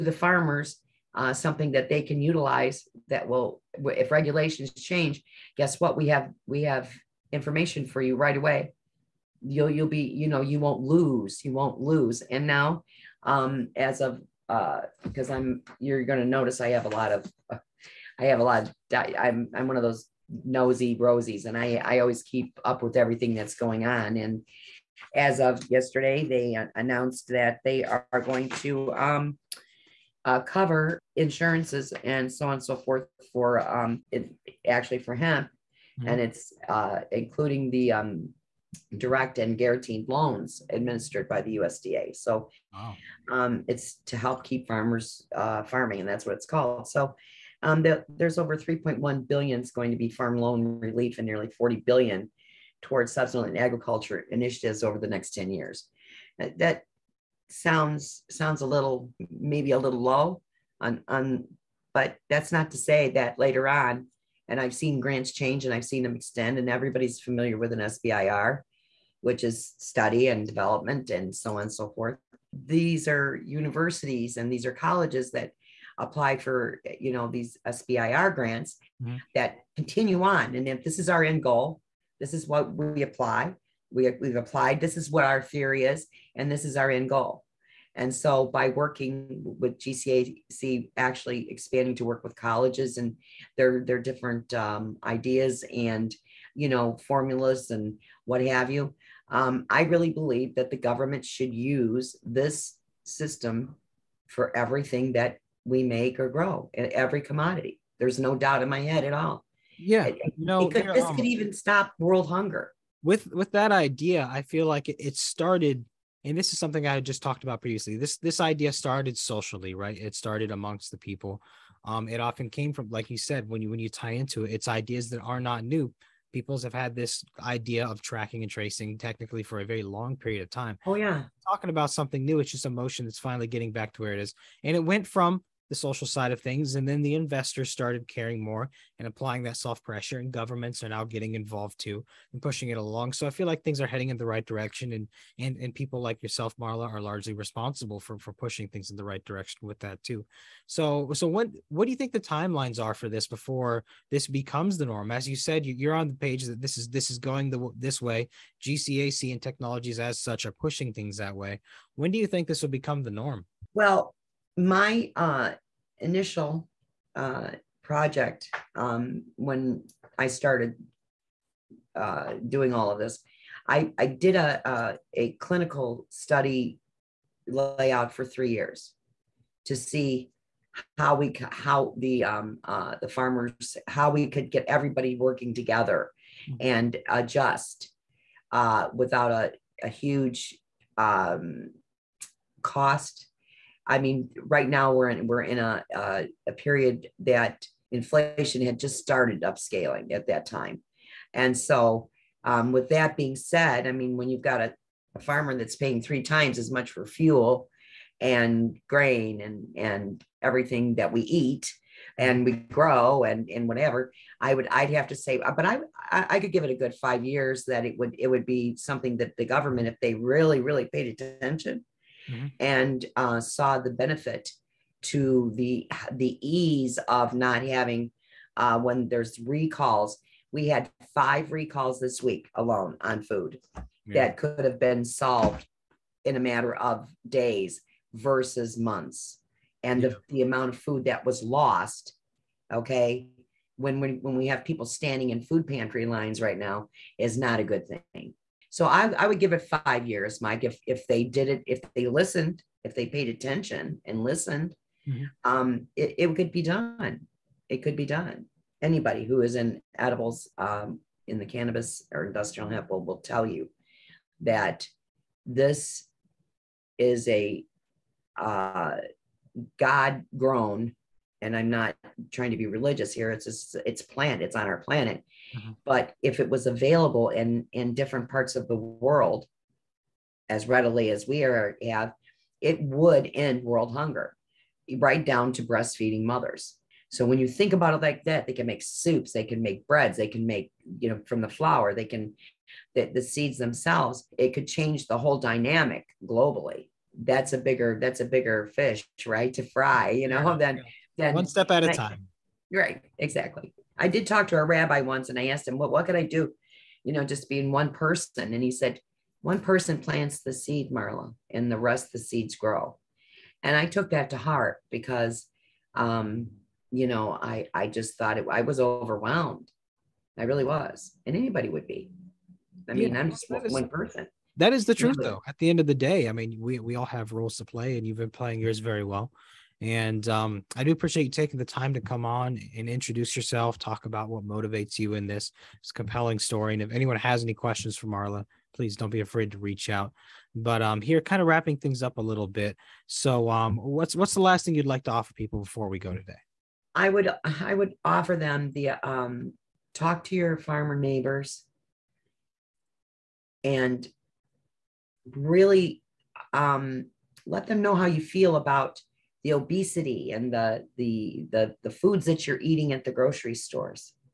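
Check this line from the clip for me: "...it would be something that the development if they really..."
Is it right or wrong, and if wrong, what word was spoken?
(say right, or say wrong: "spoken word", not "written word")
wrong: "government", not "development".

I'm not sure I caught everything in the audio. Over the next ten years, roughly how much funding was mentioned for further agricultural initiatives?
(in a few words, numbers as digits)
nearly 40 billion.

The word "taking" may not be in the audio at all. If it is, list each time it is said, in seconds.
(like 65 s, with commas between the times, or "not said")
331 s.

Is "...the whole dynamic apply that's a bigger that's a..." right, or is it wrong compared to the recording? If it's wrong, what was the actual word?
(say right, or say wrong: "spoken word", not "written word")
wrong: "globally", not "apply".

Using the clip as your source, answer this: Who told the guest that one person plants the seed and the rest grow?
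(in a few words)
a rabbi.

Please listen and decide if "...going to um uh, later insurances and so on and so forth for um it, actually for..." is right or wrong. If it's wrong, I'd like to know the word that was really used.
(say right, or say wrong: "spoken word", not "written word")
wrong: "cover", not "later".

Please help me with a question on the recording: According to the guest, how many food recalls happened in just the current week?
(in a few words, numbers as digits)
5.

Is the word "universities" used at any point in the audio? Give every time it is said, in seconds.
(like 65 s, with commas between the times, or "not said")
73 s.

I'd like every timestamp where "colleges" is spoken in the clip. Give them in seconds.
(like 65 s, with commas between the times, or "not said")
74 s, 92 s.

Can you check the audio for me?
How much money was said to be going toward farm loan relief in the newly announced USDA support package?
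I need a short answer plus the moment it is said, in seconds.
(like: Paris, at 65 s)
3.1 billion, at 48 s.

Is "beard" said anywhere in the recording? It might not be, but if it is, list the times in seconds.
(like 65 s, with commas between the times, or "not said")
not said.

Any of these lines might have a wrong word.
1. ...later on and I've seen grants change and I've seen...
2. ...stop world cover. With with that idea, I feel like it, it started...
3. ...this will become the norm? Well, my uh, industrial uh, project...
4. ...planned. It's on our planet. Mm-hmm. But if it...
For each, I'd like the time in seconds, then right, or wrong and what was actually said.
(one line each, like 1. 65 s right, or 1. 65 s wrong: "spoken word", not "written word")
1. 63 s right
2. 111 s wrong: "hunger", not "cover"
3. 162 s wrong: "initial", not "industrial"
4. 274 s right.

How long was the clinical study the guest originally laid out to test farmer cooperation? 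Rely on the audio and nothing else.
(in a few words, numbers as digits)
3 years.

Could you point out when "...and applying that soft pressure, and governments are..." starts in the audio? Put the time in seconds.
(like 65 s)
138 s.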